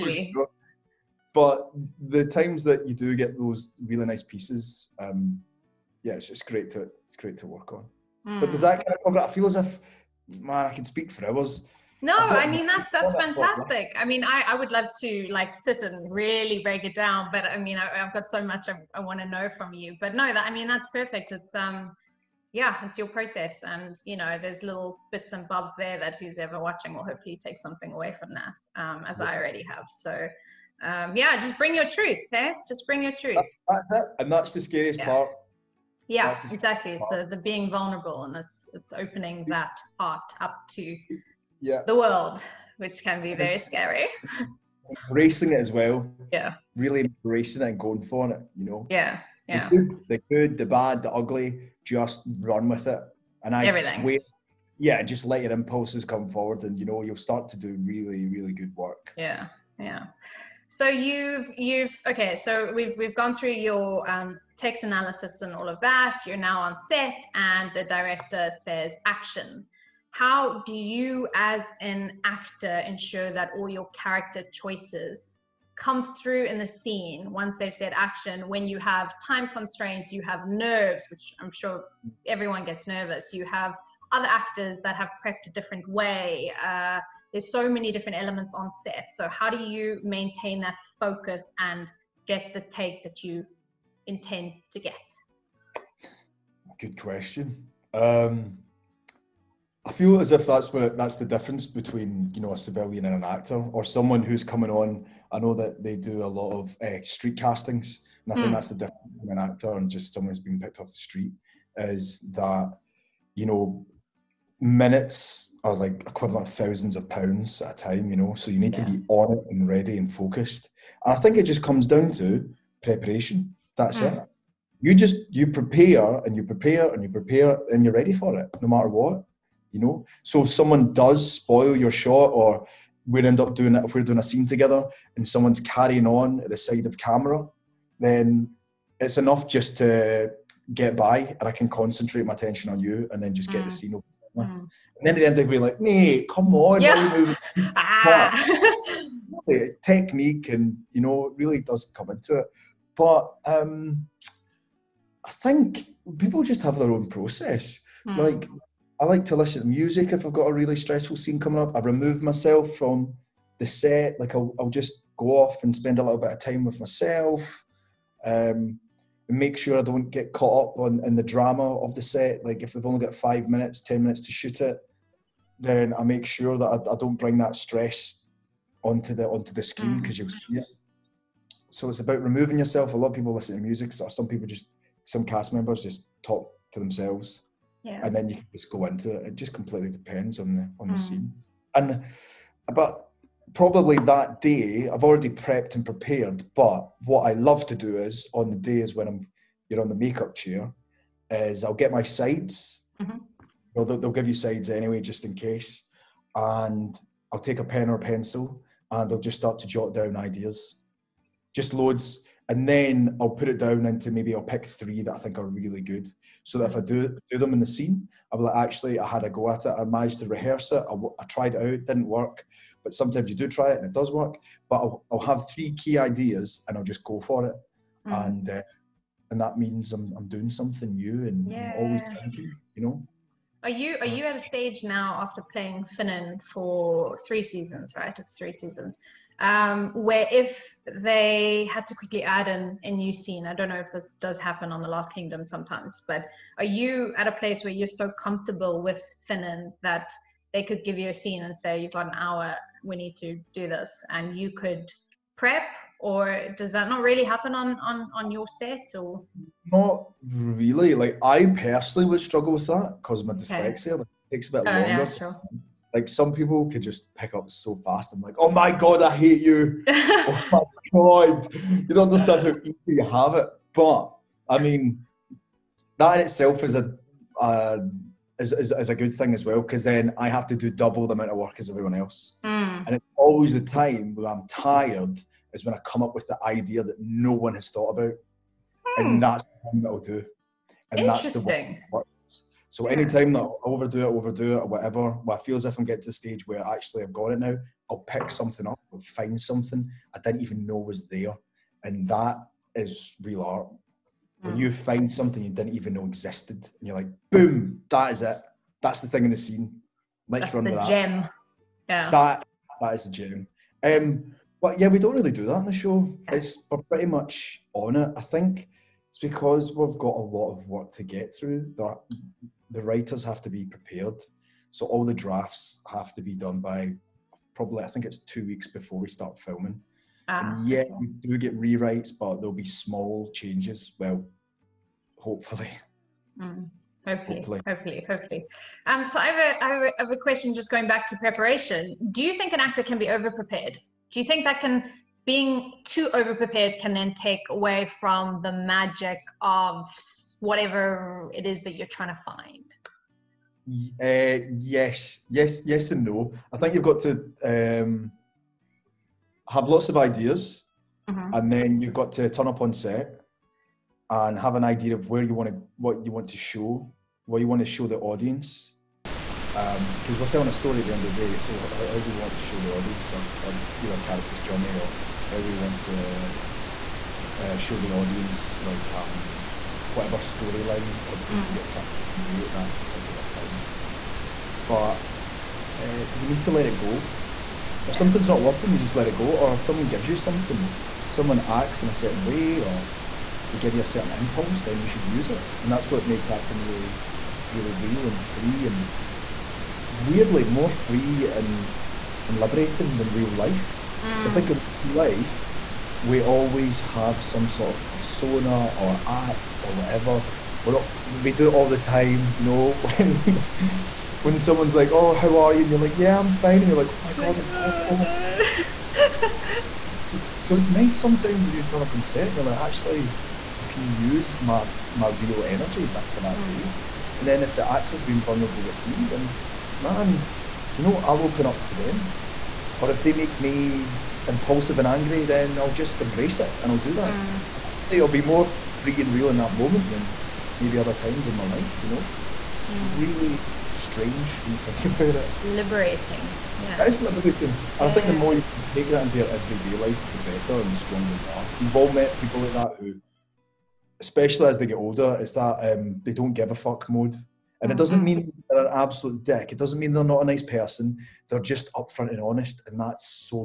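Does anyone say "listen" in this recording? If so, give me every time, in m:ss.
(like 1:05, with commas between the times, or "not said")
2:39, 3:03.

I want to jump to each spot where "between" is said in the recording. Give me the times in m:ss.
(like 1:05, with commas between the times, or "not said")
1:41, 1:49.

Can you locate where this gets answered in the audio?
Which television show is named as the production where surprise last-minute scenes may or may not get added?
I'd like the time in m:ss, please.
4:04.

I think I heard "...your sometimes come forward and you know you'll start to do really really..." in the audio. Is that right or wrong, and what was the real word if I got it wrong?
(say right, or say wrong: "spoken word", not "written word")
wrong: "impulses", not "sometimes".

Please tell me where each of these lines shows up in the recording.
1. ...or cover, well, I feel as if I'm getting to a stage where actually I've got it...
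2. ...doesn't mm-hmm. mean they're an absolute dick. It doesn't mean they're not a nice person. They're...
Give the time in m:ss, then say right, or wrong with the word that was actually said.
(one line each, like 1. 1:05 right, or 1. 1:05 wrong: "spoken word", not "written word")
1. 4:54 wrong: "whatever", not "cover"
2. 7:37 right.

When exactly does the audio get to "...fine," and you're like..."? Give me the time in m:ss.
6:56.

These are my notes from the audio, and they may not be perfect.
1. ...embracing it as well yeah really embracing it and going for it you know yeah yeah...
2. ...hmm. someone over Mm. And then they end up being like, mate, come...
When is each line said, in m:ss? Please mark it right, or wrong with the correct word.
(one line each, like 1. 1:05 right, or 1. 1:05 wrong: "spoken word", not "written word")
1. 0:45 right
2. 2:23 wrong: "scene", not "someone".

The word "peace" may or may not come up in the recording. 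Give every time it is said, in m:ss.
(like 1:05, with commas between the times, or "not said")
not said.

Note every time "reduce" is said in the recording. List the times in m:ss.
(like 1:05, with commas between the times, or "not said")
not said.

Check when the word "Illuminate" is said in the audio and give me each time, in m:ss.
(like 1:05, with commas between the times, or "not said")
not said.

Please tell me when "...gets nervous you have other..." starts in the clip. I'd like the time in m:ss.
1:22.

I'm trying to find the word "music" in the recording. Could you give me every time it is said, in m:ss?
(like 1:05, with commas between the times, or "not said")
2:39, 3:03.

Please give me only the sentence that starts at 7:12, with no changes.
Or if they make me impulsive and angry, then I'll just embrace it and I'll do that.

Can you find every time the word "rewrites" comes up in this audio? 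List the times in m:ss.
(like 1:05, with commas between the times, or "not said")
5:31.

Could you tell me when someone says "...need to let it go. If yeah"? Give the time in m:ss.
6:26.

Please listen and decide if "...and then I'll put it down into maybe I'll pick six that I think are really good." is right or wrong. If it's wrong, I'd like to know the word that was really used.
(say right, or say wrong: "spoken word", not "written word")
wrong: "three", not "six".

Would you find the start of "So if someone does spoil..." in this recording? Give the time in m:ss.
2:10.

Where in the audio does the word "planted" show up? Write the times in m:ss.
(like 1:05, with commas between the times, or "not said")
not said.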